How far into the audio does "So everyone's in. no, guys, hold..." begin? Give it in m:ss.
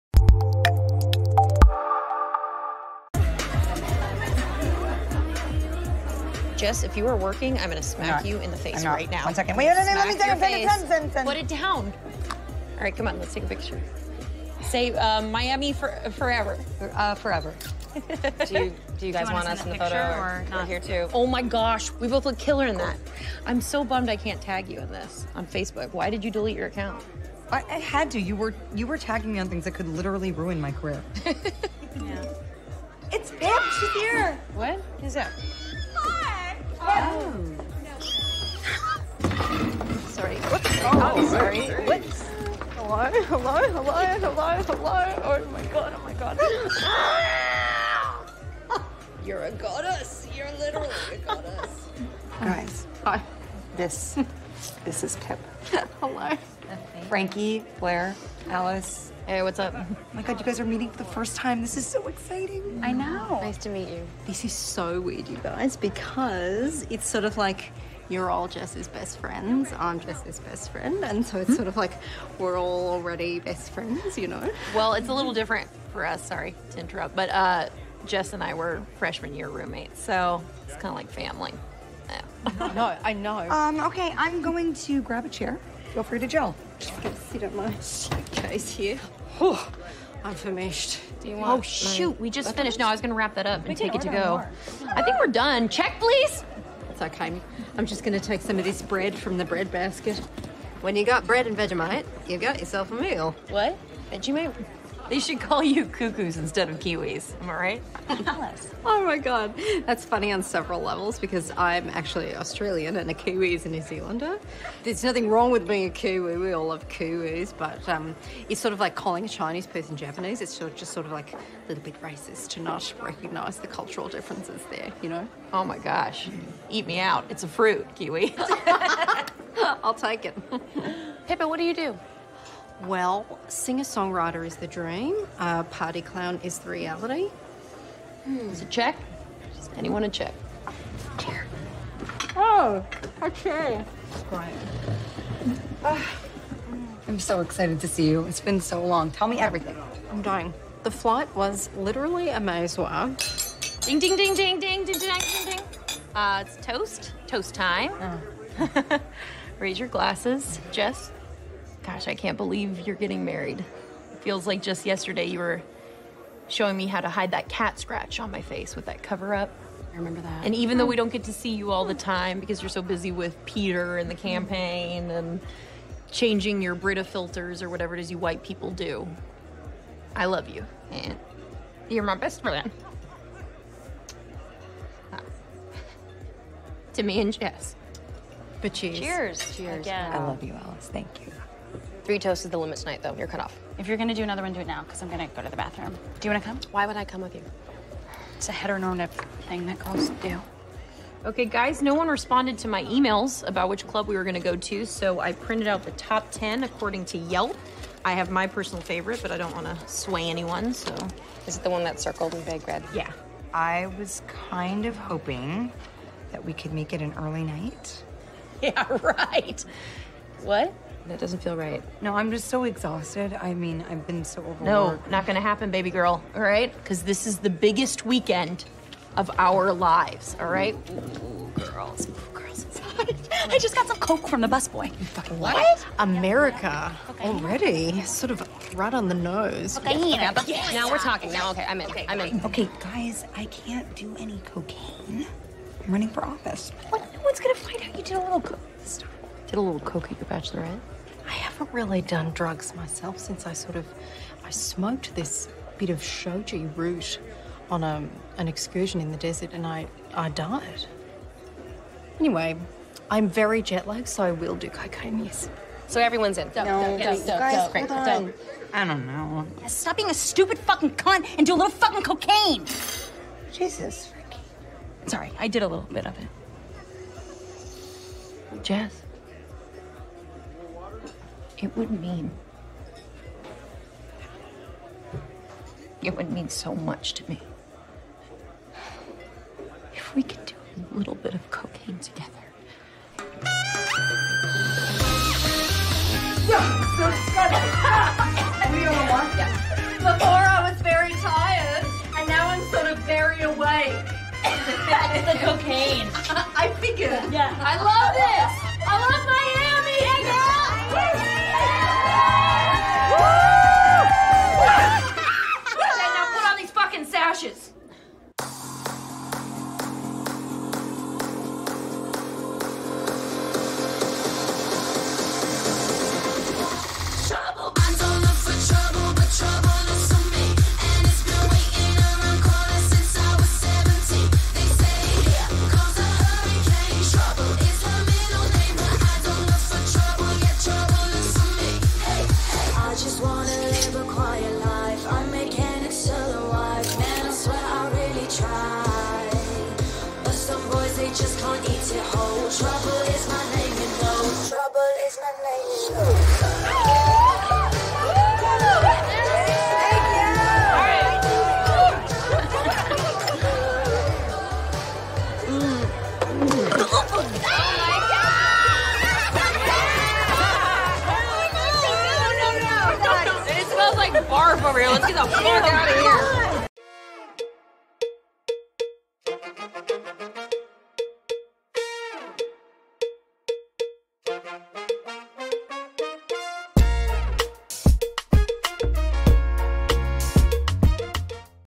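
4:25.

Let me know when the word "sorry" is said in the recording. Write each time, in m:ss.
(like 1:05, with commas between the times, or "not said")
0:41, 1:16, 4:35.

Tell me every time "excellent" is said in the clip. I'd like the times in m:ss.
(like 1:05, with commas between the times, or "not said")
not said.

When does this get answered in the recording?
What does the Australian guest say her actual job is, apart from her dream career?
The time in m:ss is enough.
2:15.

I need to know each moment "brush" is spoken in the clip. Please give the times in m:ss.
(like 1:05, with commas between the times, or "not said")
not said.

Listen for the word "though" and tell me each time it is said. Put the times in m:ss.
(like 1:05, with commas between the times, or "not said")
2:50, 3:13.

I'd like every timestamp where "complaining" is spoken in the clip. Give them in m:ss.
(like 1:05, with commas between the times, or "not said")
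not said.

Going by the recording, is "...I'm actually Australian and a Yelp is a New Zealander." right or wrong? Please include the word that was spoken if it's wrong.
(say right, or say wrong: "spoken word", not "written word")
wrong: "Kiwi", not "Yelp".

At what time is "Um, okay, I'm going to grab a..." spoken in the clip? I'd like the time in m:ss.
1:23.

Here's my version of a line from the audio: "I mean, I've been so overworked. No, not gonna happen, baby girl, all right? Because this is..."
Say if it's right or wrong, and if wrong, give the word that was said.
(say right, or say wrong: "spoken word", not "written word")
right.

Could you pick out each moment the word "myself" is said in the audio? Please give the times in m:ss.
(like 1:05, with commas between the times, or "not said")
4:12.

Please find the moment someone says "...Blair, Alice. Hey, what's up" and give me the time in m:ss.
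0:57.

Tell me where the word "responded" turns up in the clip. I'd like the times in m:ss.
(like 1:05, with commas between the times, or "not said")
3:22.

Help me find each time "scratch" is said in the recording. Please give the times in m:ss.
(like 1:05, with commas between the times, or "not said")
2:47.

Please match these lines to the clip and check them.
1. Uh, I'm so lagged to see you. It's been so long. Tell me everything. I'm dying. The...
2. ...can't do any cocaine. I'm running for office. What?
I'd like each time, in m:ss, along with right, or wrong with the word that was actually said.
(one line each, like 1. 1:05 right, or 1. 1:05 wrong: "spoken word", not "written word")
1. 2:25 wrong: "excited", not "lagged"
2. 4:03 right.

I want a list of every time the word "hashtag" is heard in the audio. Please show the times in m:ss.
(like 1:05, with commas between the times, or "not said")
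not said.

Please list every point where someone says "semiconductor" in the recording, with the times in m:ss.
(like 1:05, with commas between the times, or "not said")
not said.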